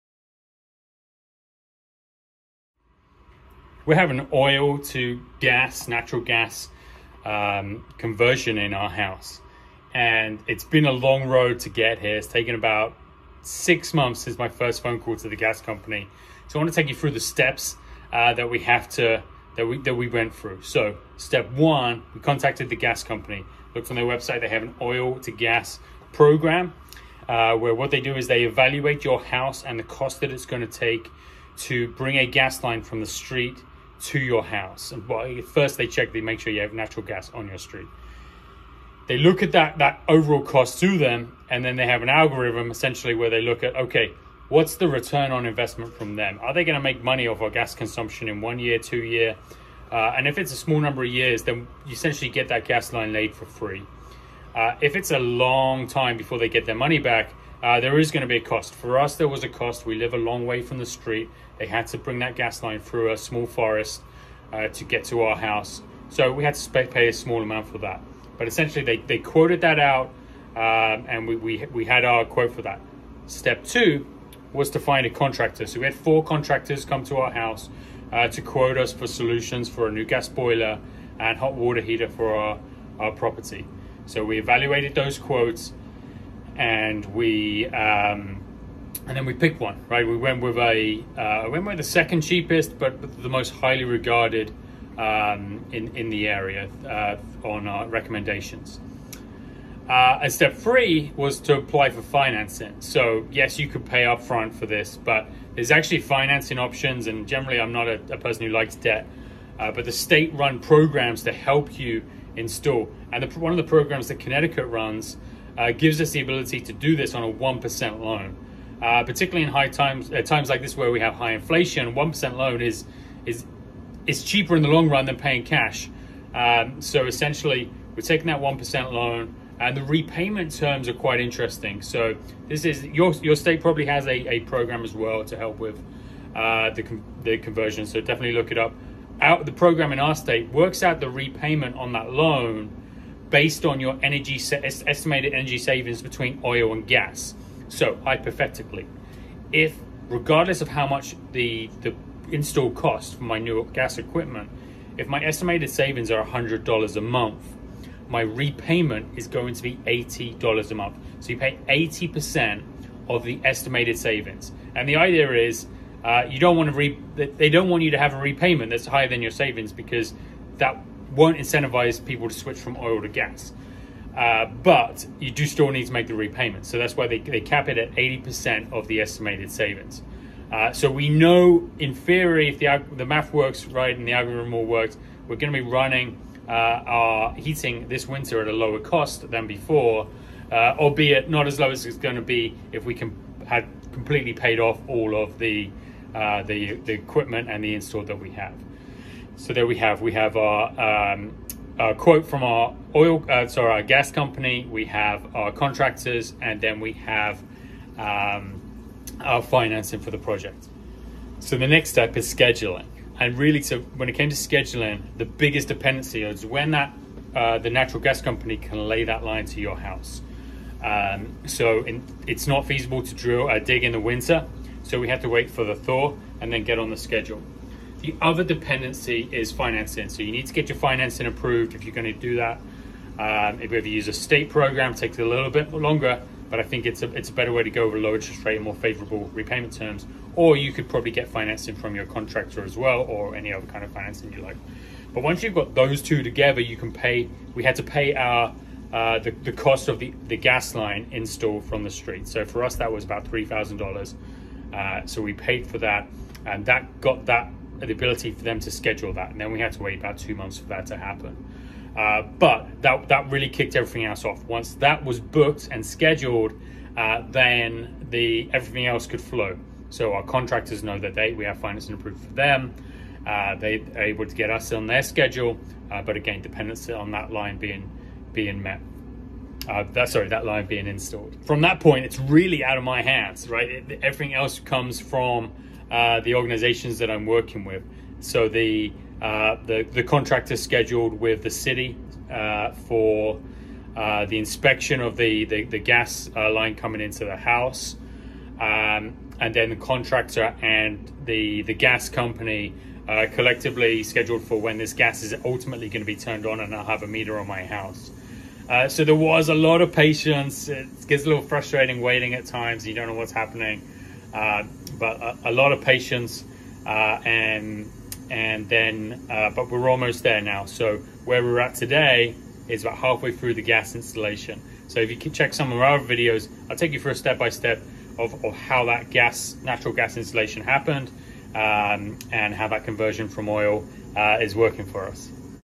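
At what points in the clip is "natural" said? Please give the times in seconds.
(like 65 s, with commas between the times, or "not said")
5 s, 36 s, 217 s, 329 s.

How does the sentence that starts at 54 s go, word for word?
Uh, if it's a long time before they get their money back, uh, there is going to be a cost.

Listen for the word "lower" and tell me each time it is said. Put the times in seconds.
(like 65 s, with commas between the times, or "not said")
188 s, 237 s.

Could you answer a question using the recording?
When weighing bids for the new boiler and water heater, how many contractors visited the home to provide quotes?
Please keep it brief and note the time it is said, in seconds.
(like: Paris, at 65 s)
4, at 75 s.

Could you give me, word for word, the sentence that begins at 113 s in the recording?
And the, one of the programs that Connecticut runs uh, gives us the ability to do this on a 1% loan.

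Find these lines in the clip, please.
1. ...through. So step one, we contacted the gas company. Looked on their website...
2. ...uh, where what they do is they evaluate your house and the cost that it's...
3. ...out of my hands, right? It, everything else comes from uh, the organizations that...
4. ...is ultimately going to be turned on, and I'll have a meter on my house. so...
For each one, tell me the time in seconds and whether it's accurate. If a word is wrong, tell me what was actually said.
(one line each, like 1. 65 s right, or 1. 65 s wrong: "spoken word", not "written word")
1. 20 s right
2. 27 s right
3. 282 s right
4. 305 s right.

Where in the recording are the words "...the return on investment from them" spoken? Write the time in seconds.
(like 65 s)
44 s.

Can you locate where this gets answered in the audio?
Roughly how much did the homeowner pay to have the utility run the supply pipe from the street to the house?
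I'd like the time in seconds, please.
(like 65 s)
253 s.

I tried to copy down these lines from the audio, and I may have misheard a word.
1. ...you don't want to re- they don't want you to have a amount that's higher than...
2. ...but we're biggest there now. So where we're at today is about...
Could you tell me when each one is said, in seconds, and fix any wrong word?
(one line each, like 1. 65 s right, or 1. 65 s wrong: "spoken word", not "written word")
1. 166 s wrong: "repayment", not "amount"
2. 319 s wrong: "almost", not "biggest".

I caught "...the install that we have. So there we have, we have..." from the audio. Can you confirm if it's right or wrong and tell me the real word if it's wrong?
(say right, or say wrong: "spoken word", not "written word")
right.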